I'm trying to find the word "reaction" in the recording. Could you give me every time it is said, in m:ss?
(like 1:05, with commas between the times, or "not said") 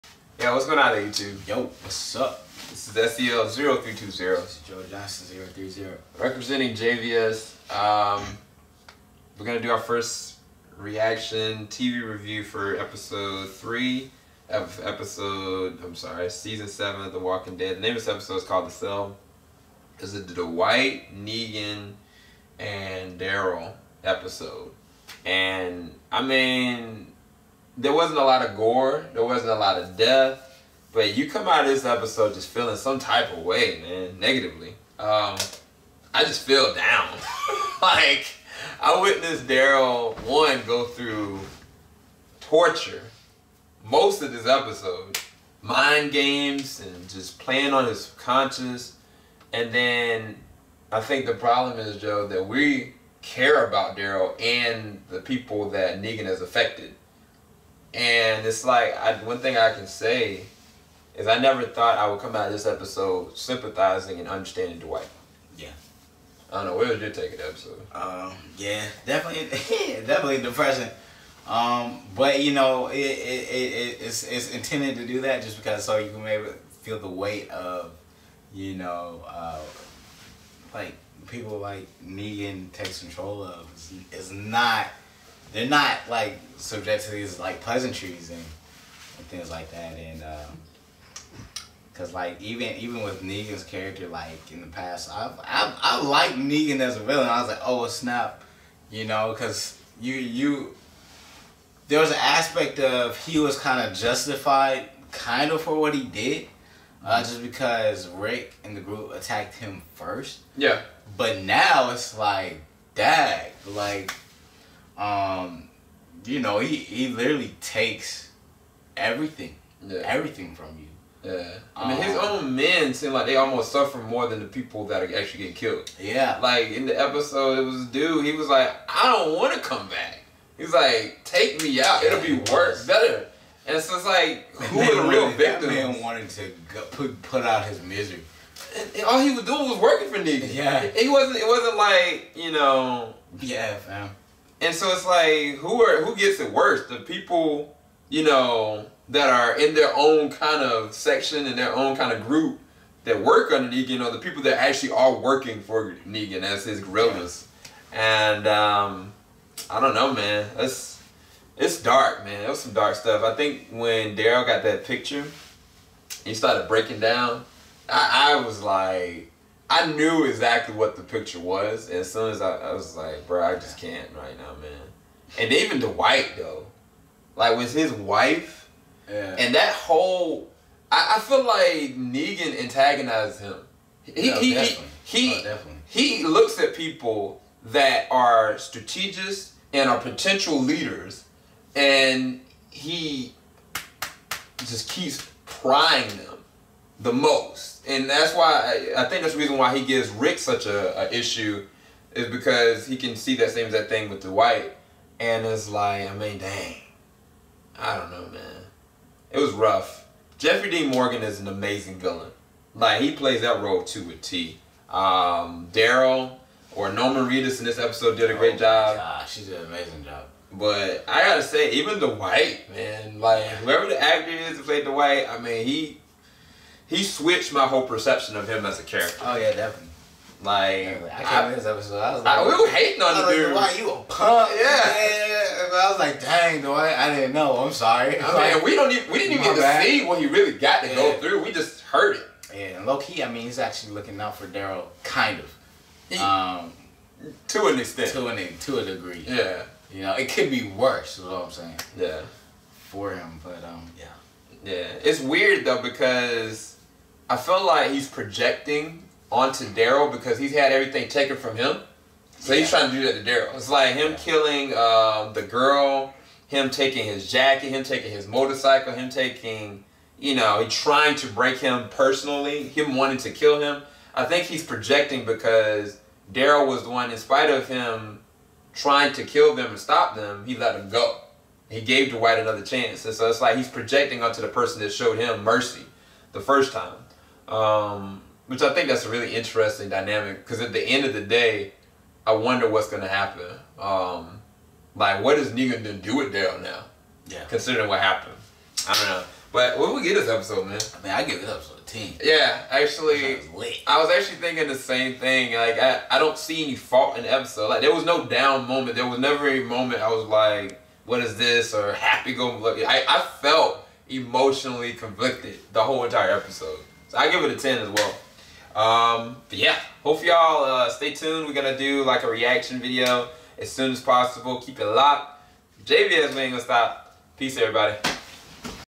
0:10, 5:22.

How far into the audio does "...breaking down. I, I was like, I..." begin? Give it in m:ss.
2:46.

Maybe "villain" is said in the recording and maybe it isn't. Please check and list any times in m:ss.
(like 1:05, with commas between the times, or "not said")
1:37, 3:31.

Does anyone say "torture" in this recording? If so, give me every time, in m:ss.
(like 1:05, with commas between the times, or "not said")
0:42.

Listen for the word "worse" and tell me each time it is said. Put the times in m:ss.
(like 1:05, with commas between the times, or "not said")
2:12, 2:26, 4:10.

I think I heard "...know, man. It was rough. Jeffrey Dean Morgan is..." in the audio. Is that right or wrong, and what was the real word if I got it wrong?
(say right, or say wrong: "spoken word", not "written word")
right.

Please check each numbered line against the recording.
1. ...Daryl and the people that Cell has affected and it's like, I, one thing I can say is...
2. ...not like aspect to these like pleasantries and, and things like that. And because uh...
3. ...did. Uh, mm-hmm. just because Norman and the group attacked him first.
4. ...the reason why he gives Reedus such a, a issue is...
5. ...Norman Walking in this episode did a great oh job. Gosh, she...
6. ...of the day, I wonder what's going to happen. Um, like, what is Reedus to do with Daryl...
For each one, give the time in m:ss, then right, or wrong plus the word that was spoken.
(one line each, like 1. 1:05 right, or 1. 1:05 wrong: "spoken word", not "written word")
1. 0:53 wrong: "Negan", not "Cell"
2. 1:25 wrong: "subject", not "aspect"
3. 1:46 wrong: "Rick", not "Norman"
4. 3:19 wrong: "Rick", not "Reedus"
5. 3:36 wrong: "Reedus", not "Walking"
6. 4:51 wrong: "Negan", not "Reedus".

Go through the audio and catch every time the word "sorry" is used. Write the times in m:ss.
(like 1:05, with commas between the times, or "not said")
0:15, 3:57.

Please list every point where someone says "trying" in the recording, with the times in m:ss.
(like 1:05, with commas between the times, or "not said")
4:22, 4:30, 4:38.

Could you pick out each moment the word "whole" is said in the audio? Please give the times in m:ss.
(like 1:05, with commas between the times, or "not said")
2:59, 3:47, 5:15.